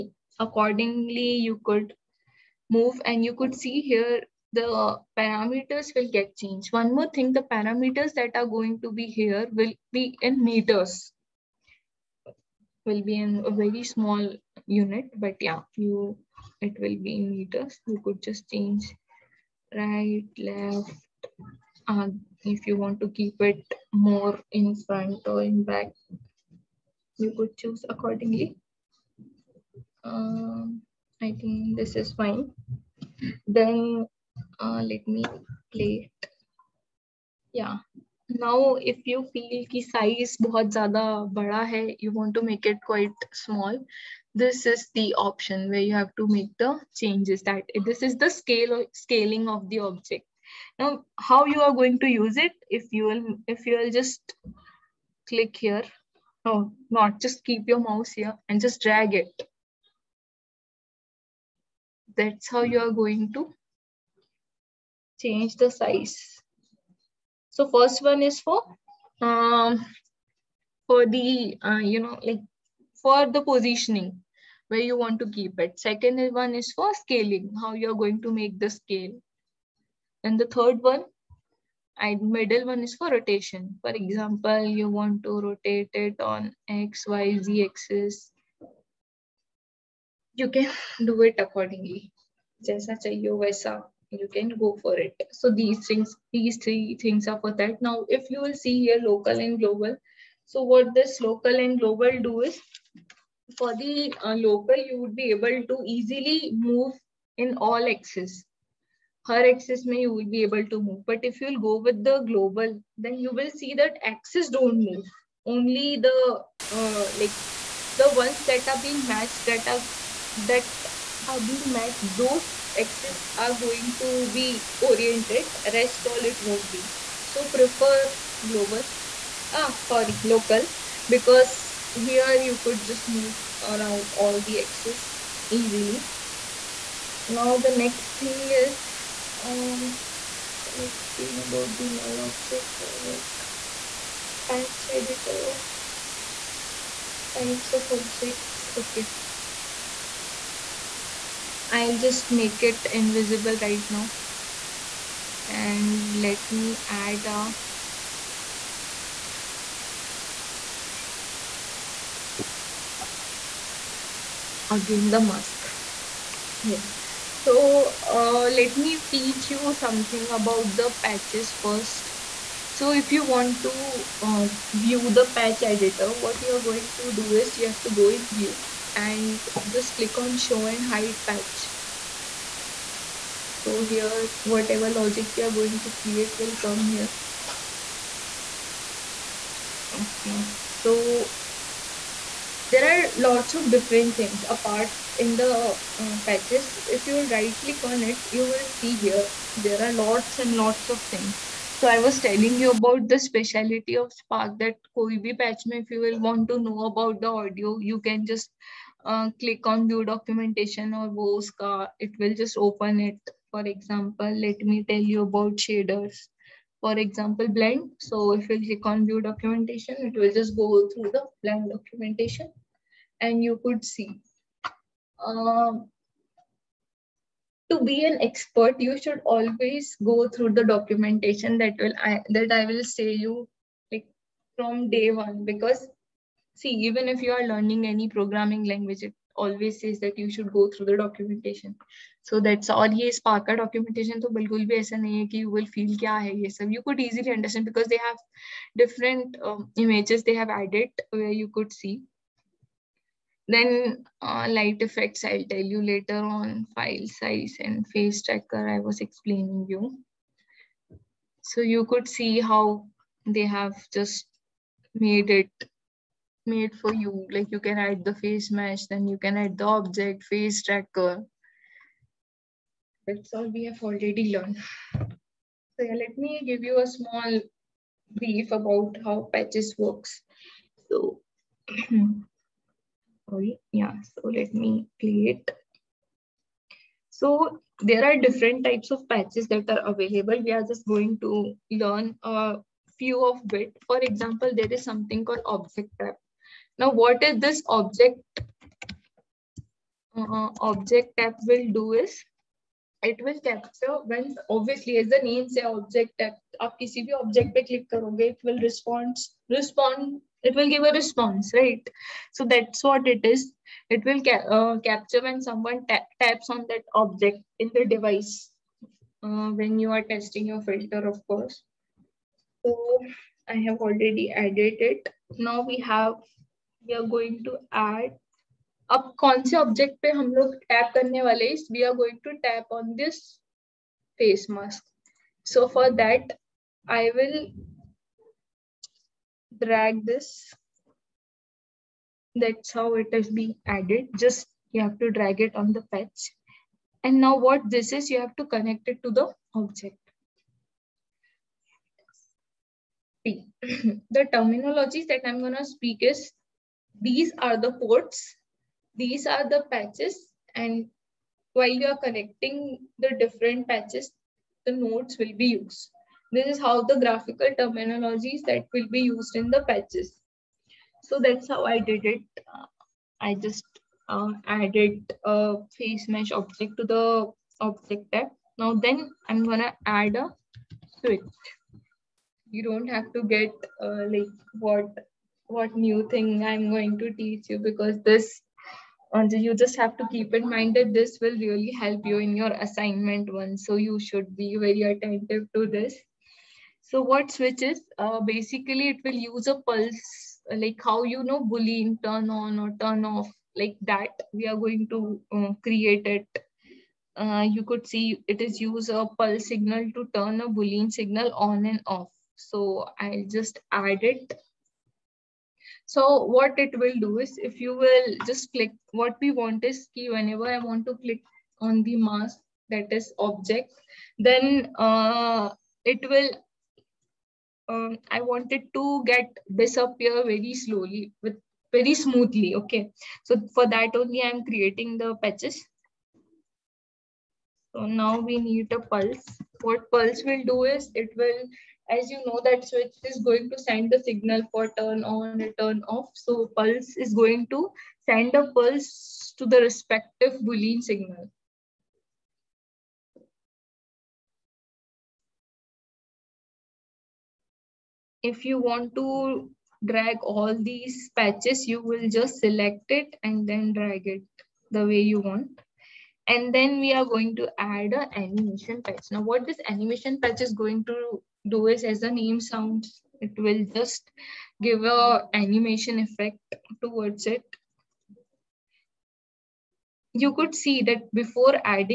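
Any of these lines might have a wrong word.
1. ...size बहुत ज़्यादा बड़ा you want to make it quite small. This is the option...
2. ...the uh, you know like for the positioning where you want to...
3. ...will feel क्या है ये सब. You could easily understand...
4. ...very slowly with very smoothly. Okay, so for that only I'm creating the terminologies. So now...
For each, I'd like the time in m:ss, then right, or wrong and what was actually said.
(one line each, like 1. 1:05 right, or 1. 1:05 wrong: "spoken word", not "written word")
1. 0:39 right
2. 1:11 right
3. 4:05 right
4. 7:10 wrong: "patches", not "terminologies".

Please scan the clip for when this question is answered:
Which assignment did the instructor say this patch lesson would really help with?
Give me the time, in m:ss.
6:32.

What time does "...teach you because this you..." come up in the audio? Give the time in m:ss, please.
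6:27.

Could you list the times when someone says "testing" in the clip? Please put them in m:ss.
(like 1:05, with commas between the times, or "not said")
5:20.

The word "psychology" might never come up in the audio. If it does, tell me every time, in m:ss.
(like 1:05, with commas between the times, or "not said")
not said.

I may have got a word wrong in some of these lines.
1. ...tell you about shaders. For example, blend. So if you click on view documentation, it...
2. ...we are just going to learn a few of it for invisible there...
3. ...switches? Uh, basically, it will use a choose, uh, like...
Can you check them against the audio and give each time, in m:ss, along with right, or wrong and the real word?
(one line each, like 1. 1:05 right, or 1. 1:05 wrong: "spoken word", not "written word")
1. 3:34 right
2. 4:50 wrong: "example", not "invisible"
3. 6:37 wrong: "pulse", not "choose".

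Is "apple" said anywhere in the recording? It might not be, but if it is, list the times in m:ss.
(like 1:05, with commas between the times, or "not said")
not said.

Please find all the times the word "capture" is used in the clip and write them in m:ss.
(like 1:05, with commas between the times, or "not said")
5:03, 5:14.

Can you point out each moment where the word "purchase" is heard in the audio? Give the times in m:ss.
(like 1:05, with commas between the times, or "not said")
not said.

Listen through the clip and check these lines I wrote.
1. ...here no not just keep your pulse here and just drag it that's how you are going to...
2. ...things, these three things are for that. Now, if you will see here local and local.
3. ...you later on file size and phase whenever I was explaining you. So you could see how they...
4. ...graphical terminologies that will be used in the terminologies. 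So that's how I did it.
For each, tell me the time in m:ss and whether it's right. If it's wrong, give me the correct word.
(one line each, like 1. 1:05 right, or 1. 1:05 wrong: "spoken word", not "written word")
1. 0:55 wrong: "mouse", not "pulse"
2. 1:35 wrong: "global", not "local"
3. 4:15 wrong: "tracker", not "whenever"
4. 6:06 wrong: "patches", not "terminologies".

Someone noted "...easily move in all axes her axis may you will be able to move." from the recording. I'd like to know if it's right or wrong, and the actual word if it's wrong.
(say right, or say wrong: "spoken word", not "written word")
right.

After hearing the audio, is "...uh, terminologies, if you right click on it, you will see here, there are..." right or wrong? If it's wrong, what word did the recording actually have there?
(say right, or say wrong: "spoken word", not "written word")
wrong: "patches", not "terminologies".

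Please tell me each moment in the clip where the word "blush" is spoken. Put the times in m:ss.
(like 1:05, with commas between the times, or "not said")
not said.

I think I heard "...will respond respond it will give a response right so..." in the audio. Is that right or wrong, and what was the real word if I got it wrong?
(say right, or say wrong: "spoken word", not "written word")
right.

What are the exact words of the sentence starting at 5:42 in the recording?
That's how it is being added.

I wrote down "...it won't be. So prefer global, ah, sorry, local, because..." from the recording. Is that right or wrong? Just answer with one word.
right.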